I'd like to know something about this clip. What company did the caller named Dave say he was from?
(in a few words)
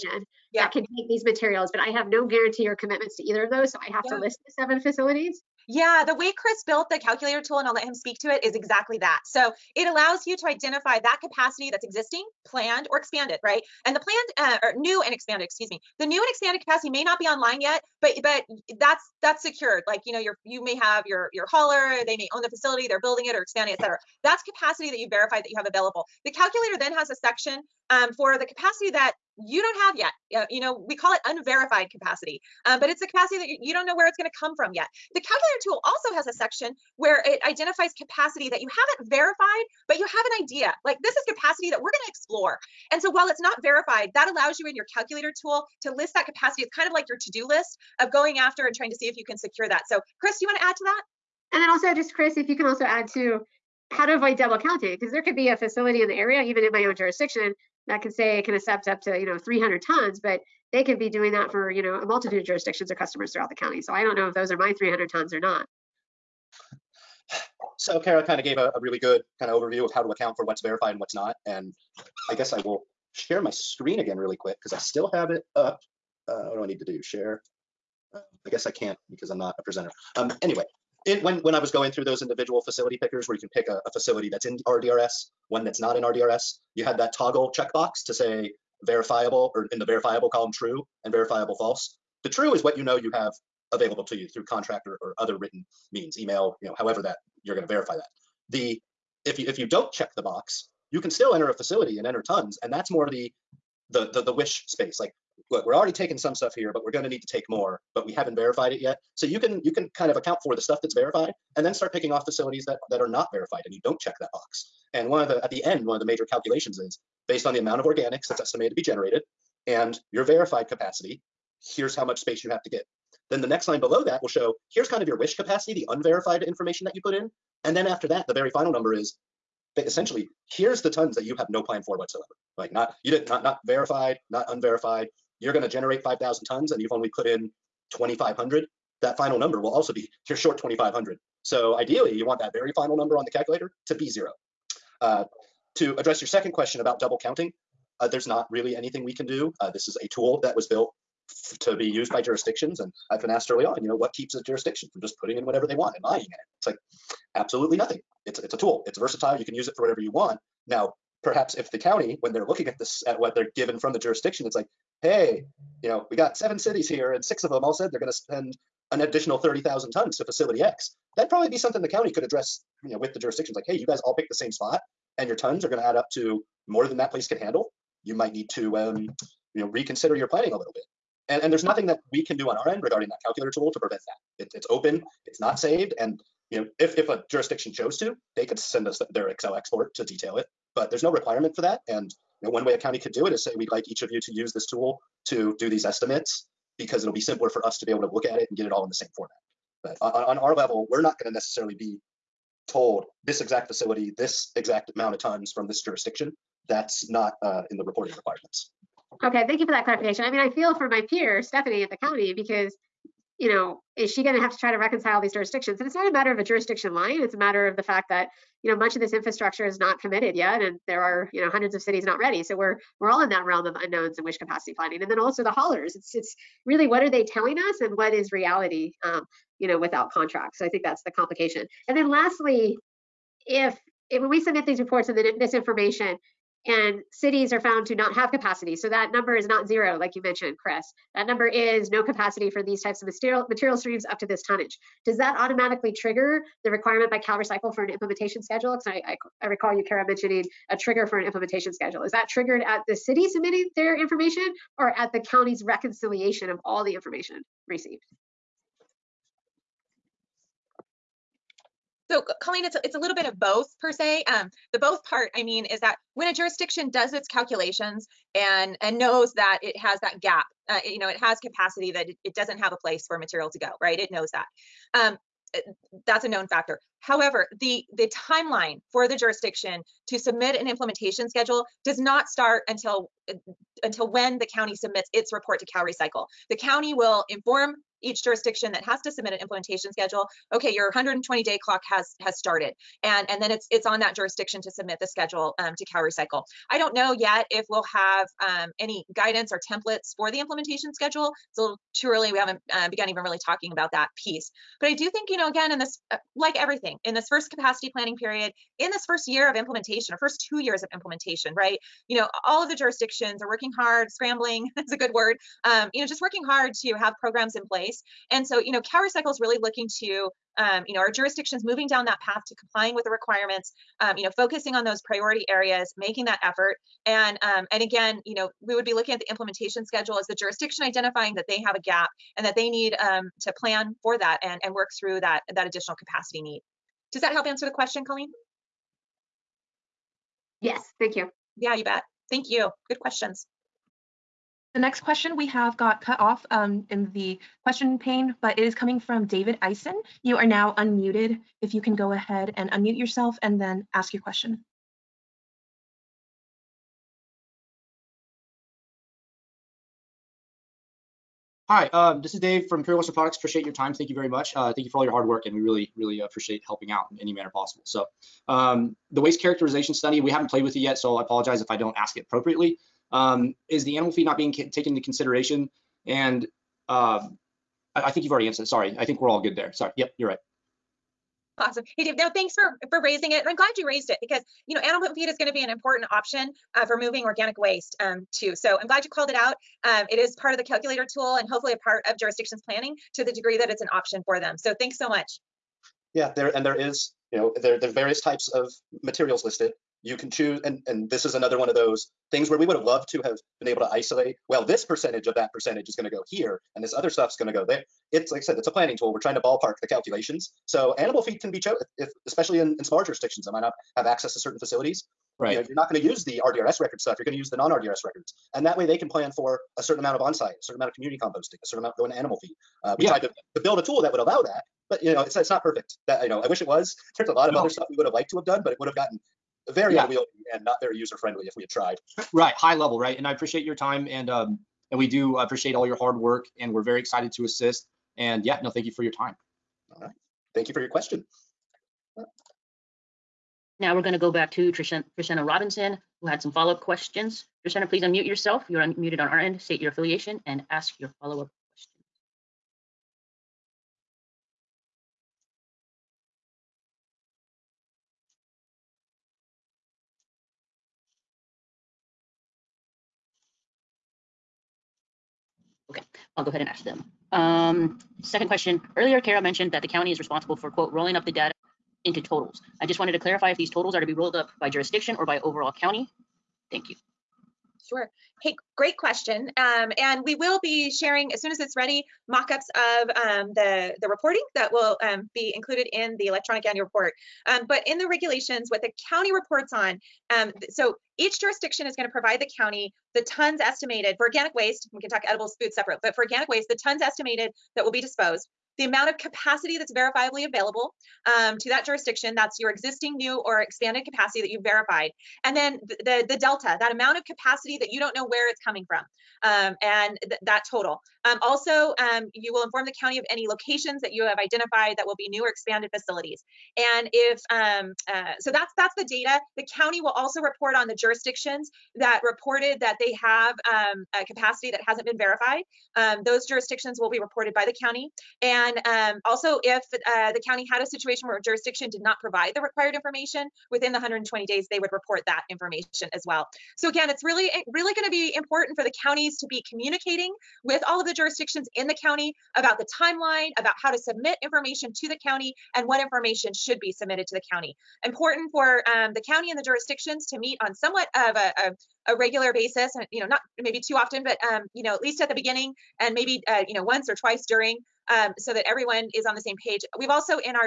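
Imperial Western Products.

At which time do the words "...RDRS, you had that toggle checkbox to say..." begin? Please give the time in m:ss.
1:26.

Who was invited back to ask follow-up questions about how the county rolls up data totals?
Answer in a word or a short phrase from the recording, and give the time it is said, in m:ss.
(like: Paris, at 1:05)
Trishana Robinson, at 7:24.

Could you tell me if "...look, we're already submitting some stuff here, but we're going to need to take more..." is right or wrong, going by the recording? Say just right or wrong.
wrong.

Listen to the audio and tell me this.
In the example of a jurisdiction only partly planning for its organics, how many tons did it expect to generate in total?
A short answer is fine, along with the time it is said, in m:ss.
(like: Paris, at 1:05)
5,000, at 2:16.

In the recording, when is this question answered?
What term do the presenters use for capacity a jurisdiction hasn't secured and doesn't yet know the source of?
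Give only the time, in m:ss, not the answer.
0:31.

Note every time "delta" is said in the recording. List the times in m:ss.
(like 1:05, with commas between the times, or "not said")
8:26.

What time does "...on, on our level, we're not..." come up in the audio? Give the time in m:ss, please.
3:20.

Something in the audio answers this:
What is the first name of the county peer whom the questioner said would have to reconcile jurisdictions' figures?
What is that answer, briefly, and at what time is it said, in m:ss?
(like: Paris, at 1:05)
Stephanie, at 3:31.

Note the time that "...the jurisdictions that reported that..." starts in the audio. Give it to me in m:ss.
8:40.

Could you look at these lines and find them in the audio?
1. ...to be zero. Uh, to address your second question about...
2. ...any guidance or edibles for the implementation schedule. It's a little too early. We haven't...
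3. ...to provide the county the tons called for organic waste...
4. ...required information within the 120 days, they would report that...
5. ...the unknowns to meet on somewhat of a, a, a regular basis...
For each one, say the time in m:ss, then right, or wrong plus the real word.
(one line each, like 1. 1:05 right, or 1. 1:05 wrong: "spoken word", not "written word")
1. 2:23 right
2. 4:58 wrong: "templates", not "edibles"
3. 8:12 wrong: "estimated", not "called"
4. 8:52 right
5. 9:09 wrong: "jurisdictions", not "unknowns".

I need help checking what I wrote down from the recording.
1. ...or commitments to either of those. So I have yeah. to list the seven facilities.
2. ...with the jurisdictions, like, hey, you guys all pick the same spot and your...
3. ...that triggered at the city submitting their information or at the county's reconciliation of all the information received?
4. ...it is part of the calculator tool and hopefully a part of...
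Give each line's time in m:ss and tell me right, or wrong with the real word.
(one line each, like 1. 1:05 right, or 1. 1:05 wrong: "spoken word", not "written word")
1. 0:02 right
2. 2:52 right
3. 4:12 right
4. 6:30 right.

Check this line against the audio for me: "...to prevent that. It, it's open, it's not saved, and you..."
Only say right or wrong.
right.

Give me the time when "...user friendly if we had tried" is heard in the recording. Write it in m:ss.
7:10.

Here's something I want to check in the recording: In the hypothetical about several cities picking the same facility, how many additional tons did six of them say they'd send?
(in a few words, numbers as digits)
30,000.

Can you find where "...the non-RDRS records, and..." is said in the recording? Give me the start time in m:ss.
6:57.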